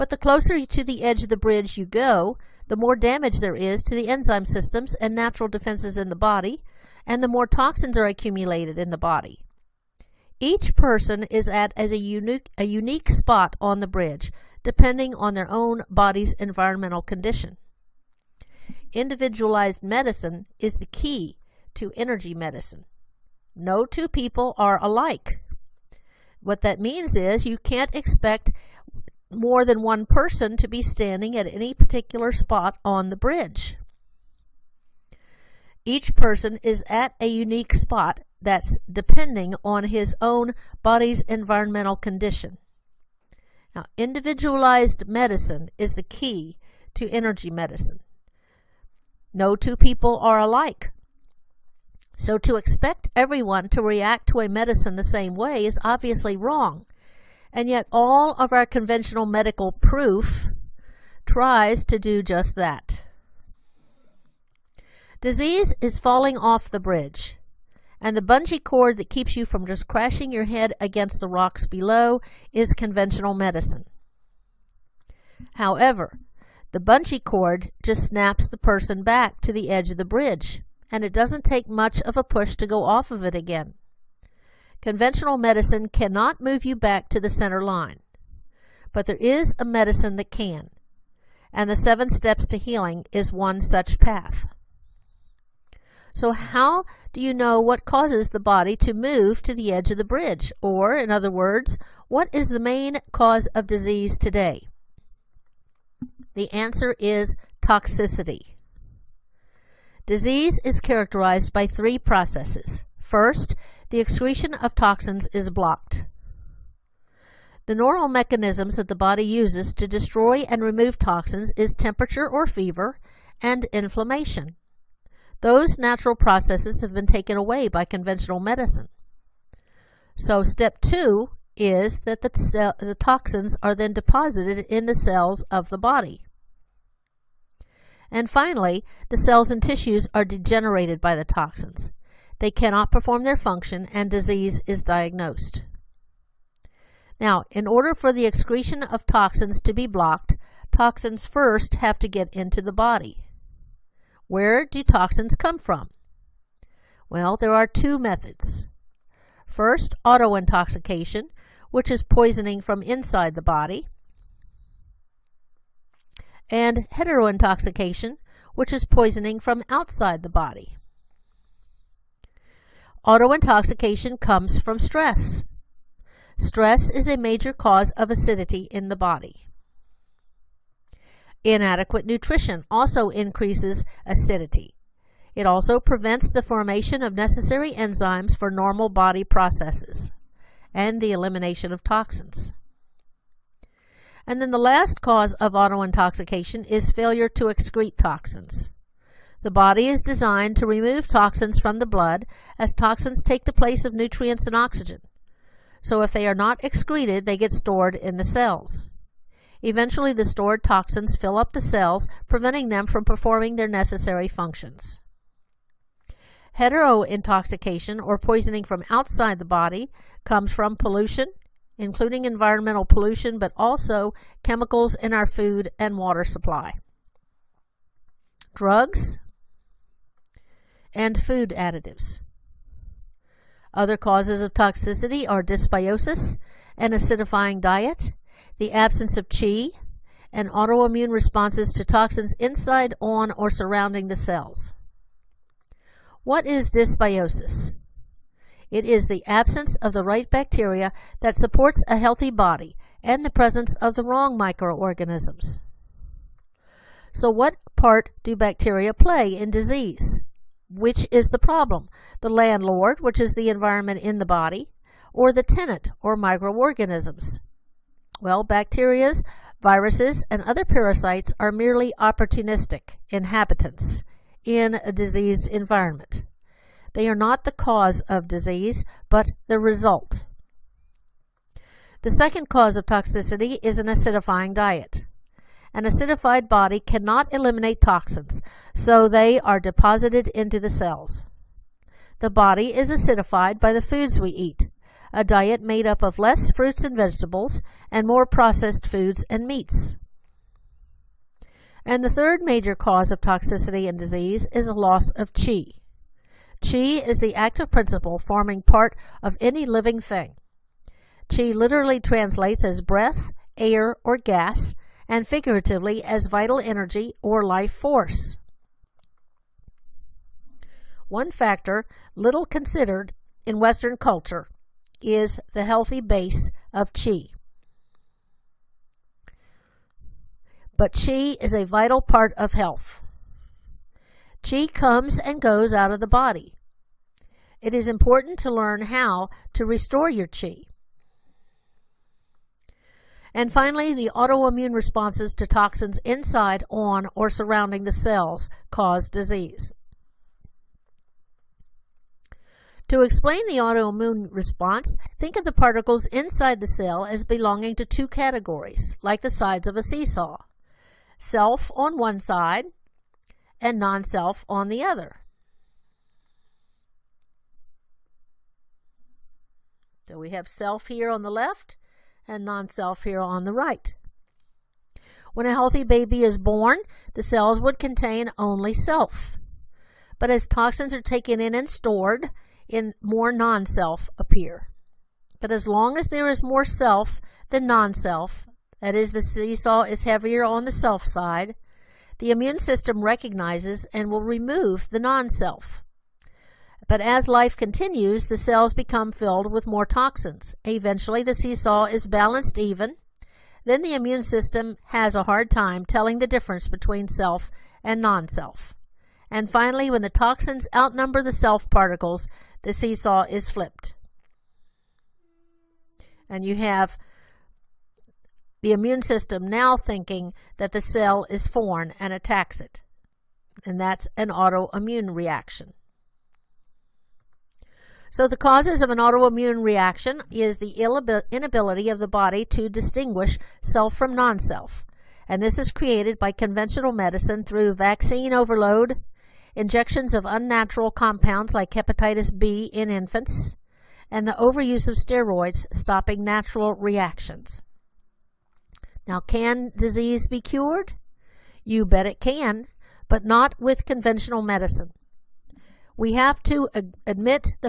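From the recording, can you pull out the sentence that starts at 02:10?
So step two is that the, the toxins are then deposited in the cells of the body.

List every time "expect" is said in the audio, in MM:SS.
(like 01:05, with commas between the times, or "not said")
00:27, 00:52.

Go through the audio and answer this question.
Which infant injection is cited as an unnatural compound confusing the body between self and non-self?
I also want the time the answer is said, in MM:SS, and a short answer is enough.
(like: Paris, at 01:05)
hepatitis B, at 07:21.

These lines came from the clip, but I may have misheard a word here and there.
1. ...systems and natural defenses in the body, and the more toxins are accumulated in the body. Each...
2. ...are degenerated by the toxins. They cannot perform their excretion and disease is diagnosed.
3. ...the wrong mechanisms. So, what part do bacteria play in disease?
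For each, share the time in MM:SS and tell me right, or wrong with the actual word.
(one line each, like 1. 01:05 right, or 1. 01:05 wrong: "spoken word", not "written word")
1. 00:04 right
2. 02:20 wrong: "function", not "excretion"
3. 04:13 wrong: "microorganisms", not "mechanisms".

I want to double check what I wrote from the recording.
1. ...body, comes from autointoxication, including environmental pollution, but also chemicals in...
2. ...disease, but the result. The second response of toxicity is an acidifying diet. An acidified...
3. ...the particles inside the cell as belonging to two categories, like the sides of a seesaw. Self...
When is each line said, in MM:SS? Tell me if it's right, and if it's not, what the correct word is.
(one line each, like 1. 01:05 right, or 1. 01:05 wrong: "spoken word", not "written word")
1. 03:39 wrong: "pollution", not "autointoxication"
2. 04:38 wrong: "cause", not "response"
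3. 05:55 right.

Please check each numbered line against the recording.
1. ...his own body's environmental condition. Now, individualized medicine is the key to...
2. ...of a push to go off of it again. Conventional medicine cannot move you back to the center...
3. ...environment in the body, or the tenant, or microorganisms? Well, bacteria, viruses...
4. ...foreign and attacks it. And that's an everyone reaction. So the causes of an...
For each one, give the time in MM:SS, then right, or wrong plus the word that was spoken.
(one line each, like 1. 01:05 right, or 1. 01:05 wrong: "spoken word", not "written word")
1. 00:39 right
2. 01:22 right
3. 04:23 right
4. 07:01 wrong: "autoimmune", not "everyone".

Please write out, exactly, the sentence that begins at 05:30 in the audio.
But qi is a vital part of health.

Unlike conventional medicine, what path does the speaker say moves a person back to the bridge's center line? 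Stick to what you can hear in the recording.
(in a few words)
the seven steps to healing.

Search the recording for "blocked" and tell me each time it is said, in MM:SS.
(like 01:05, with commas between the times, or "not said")
01:55, 02:29.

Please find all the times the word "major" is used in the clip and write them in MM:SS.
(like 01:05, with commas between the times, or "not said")
02:57, 05:02.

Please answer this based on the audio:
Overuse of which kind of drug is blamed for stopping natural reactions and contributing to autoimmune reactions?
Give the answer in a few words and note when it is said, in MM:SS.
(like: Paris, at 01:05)
steroids, at 07:24.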